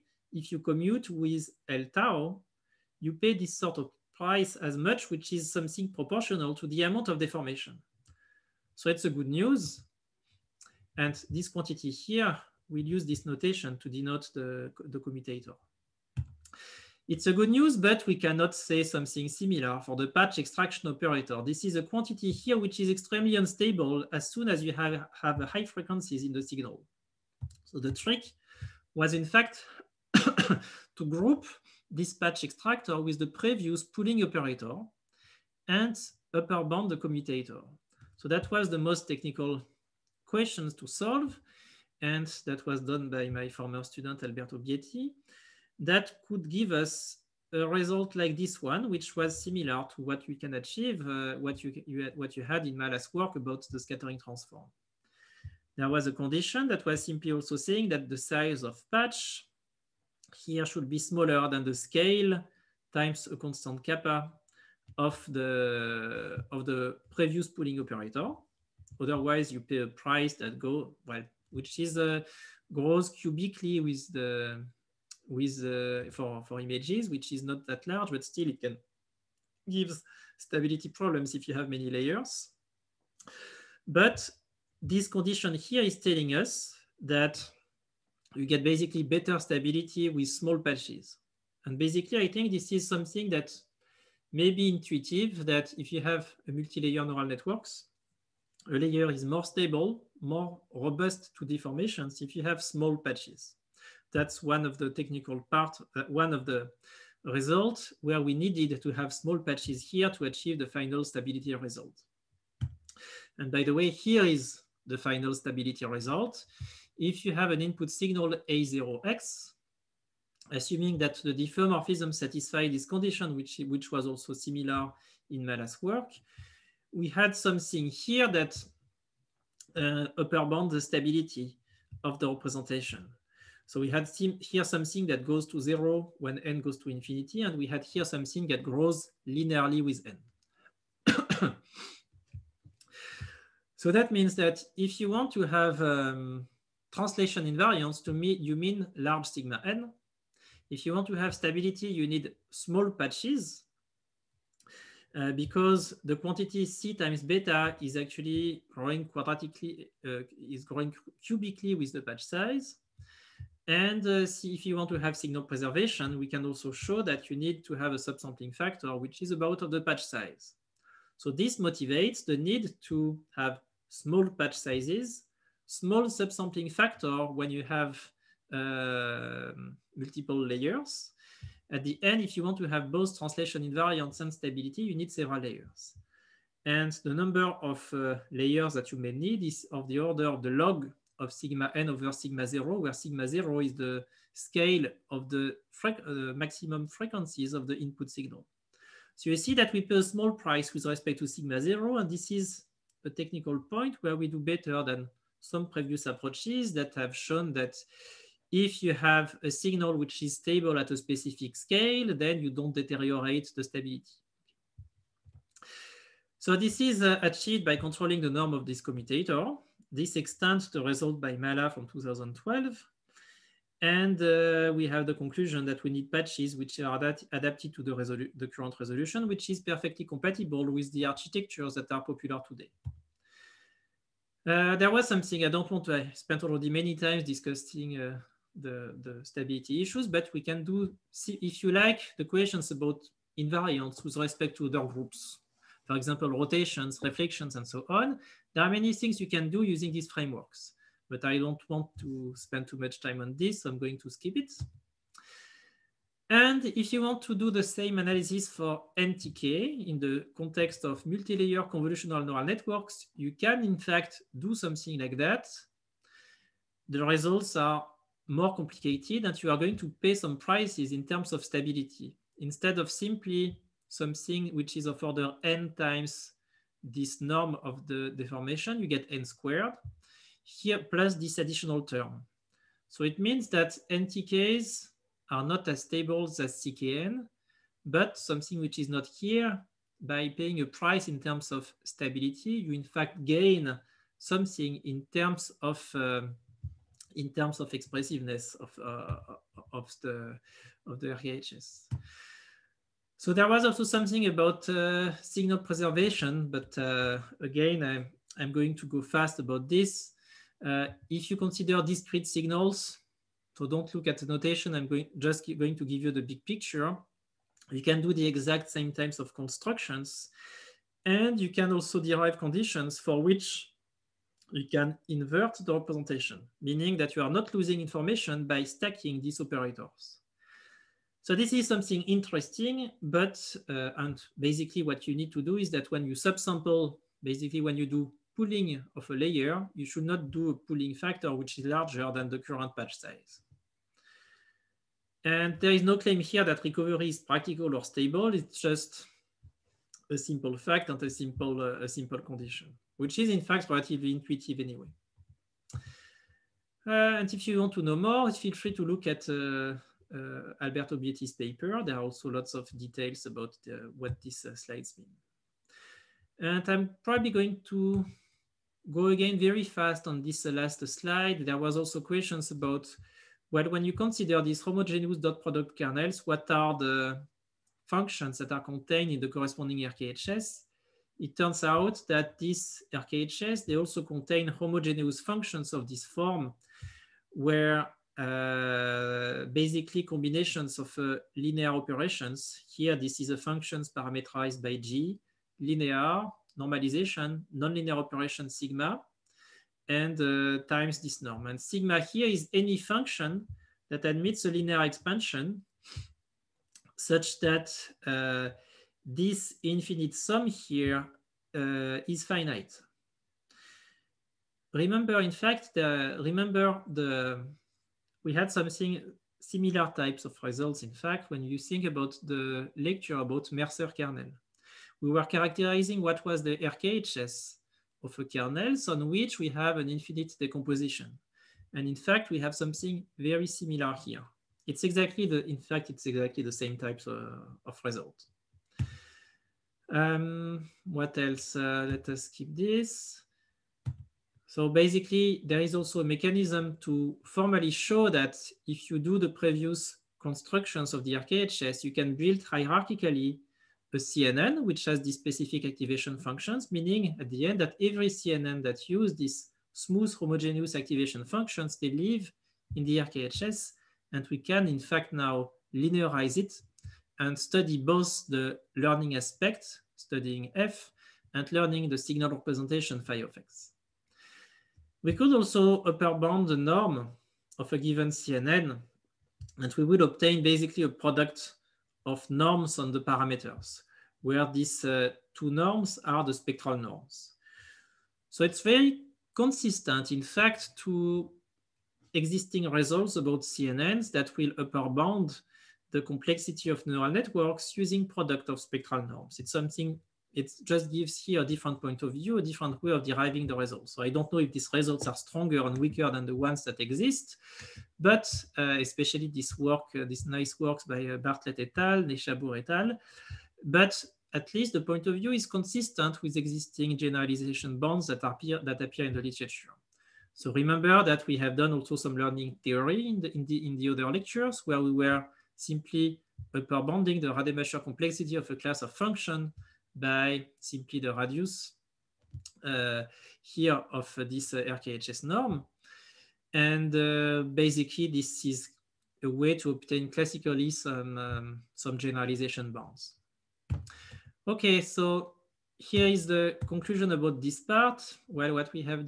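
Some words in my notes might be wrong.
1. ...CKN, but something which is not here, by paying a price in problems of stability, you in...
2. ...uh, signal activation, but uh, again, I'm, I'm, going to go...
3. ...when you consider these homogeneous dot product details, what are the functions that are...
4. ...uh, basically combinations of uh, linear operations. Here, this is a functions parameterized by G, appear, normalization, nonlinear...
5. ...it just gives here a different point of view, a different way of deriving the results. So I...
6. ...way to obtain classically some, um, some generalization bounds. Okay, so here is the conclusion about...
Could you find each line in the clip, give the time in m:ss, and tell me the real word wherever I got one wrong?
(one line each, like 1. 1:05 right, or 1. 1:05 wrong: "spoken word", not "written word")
1. 4:46 wrong: "terms", not "problems"
2. 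5:04 wrong: "preservation", not "activation"
3. 6:13 wrong: "kernels", not "details"
4. 6:28 wrong: "linear", not "appear"
5. 8:20 right
6. 8:59 right.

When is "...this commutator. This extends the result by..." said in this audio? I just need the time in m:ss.
3:38.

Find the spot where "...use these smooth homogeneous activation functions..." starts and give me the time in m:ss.
7:38.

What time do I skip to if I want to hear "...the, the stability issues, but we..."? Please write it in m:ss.
3:58.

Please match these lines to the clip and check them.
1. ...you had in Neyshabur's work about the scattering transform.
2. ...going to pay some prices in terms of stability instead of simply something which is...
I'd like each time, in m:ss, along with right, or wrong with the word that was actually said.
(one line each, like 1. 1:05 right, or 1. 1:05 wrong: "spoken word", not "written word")
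1. 0:52 wrong: "Mallat", not "Neyshabur"
2. 4:29 right.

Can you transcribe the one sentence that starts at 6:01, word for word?
There are also lots of details about the, uh, what these uh, slides mean.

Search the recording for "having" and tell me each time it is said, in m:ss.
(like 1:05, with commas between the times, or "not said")
not said.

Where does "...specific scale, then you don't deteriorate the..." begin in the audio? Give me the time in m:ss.
3:30.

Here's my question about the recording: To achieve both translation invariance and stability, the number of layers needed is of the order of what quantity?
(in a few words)
log of sigma n over sigma 0.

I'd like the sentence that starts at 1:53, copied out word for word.
And by the way, here is the final stability result.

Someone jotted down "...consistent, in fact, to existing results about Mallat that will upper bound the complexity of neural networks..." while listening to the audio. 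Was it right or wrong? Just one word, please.
wrong.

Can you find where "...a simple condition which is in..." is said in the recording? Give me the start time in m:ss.
5:51.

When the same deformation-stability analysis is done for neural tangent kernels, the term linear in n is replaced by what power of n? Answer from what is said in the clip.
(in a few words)
n squared.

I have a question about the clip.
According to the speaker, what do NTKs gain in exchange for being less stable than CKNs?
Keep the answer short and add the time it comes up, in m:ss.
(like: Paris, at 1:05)
expressiveness, at 4:57.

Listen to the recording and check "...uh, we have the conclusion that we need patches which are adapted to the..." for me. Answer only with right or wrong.
right.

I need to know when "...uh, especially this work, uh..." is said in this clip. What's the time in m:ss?
8:28.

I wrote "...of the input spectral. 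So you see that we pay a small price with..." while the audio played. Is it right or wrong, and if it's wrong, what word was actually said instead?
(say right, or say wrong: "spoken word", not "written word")
wrong: "signal", not "spectral".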